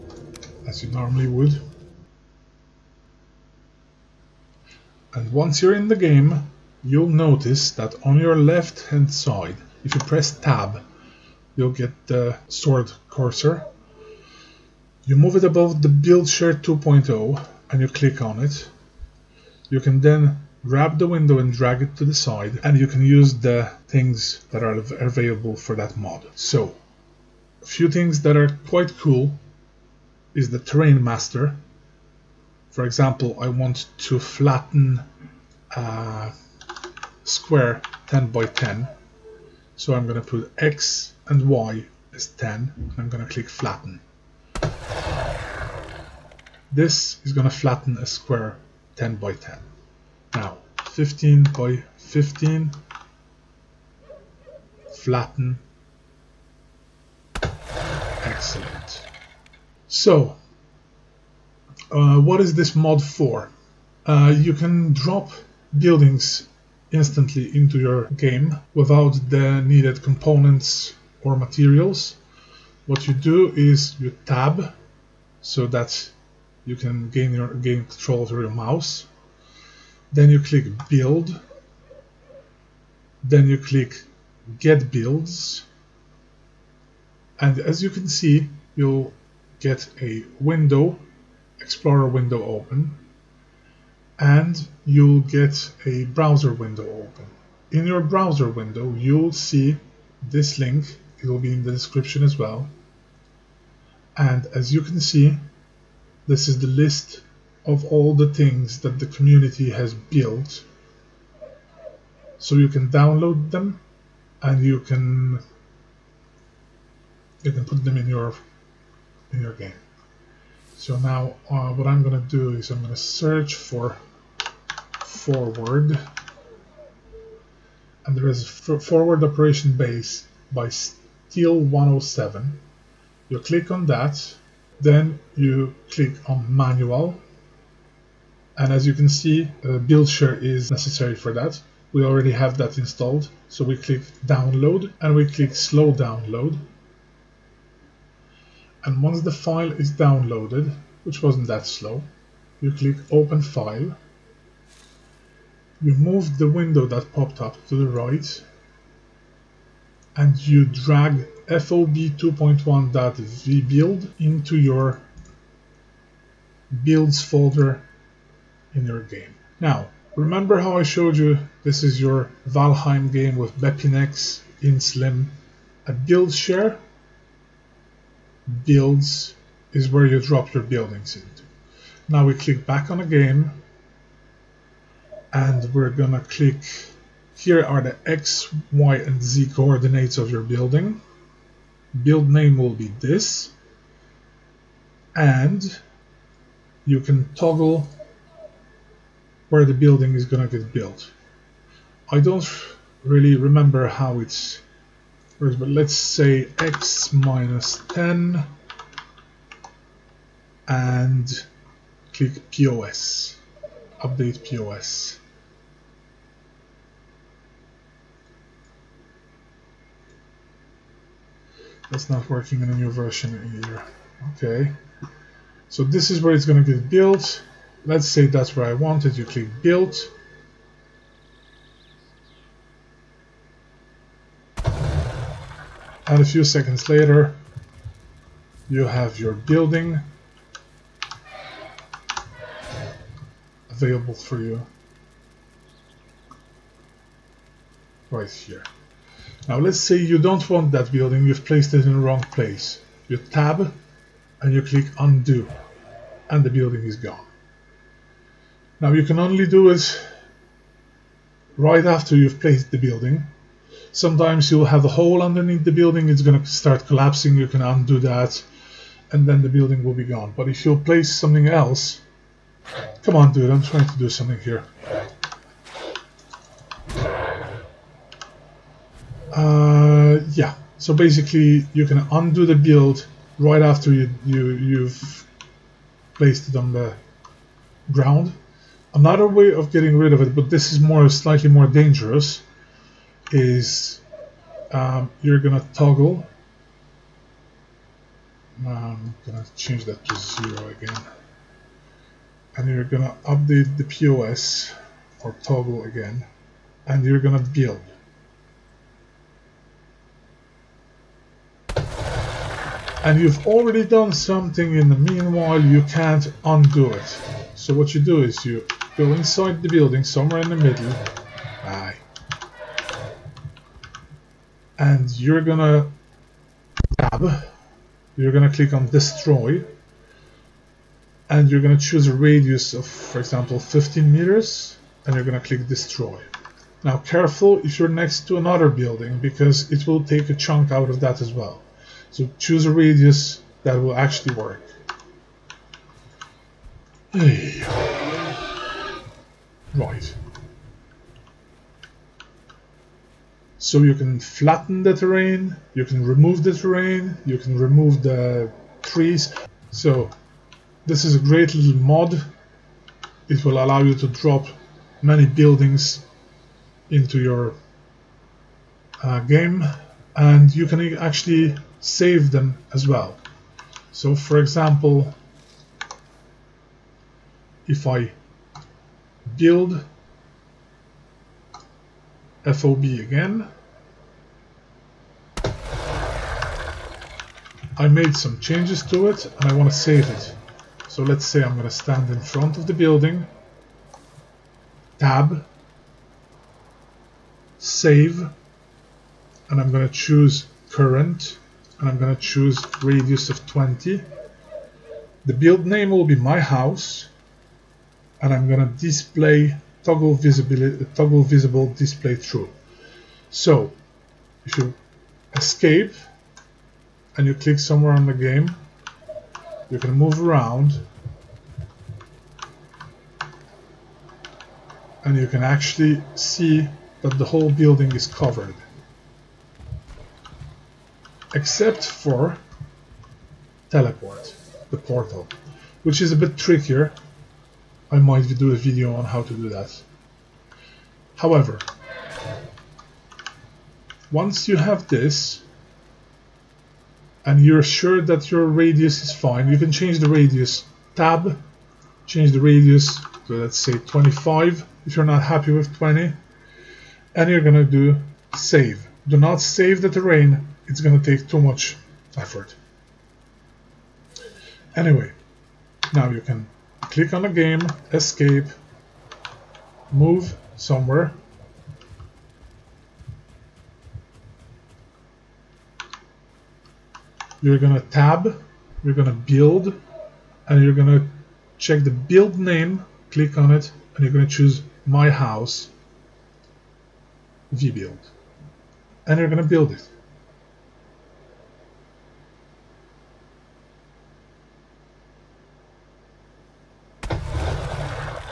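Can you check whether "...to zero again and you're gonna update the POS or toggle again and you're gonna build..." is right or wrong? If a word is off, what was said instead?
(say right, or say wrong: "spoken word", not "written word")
right.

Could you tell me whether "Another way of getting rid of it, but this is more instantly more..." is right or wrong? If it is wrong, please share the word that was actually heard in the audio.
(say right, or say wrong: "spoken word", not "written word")
wrong: "slightly", not "instantly".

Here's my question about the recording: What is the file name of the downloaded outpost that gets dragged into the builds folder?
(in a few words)
FOB 2.1.vbuild.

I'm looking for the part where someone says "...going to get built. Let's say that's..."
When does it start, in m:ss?
3:46.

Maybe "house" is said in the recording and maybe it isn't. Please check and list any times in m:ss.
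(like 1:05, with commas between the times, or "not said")
6:46, 8:05.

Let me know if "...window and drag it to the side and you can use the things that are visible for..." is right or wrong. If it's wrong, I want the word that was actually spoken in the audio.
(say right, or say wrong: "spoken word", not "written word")
wrong: "available", not "visible".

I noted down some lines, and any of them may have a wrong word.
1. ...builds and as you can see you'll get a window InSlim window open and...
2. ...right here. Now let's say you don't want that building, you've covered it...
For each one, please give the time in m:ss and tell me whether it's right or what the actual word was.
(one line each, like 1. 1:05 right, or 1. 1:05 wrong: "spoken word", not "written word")
1. 1:24 wrong: "Explorer", not "InSlim"
2. 4:08 wrong: "placed", not "covered".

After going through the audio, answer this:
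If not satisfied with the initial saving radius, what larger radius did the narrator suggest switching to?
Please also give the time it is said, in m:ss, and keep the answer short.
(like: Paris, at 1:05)
25, at 7:33.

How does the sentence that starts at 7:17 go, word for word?
I might do a video on how to do that.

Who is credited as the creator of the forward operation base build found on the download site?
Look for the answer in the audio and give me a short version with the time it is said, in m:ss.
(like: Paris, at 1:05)
steel 107, at 2:10.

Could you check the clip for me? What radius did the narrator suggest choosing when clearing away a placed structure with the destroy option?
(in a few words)
15 meters.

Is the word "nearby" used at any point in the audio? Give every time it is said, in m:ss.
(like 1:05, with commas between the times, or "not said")
not said.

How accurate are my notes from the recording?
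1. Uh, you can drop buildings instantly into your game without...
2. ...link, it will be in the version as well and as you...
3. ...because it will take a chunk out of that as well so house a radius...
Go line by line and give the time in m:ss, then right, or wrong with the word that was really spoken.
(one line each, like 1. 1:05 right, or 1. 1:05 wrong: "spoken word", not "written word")
1. 1:04 right
2. 1:40 wrong: "description", not "version"
3. 5:39 wrong: "choose", not "house".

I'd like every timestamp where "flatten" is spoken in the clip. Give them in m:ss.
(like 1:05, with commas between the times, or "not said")
0:34, 0:43, 0:47, 0:54, 5:54.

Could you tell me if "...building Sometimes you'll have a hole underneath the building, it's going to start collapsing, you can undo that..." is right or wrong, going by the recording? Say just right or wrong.
right.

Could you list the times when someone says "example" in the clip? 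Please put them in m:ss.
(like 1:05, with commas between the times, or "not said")
0:32, 5:33, 6:14.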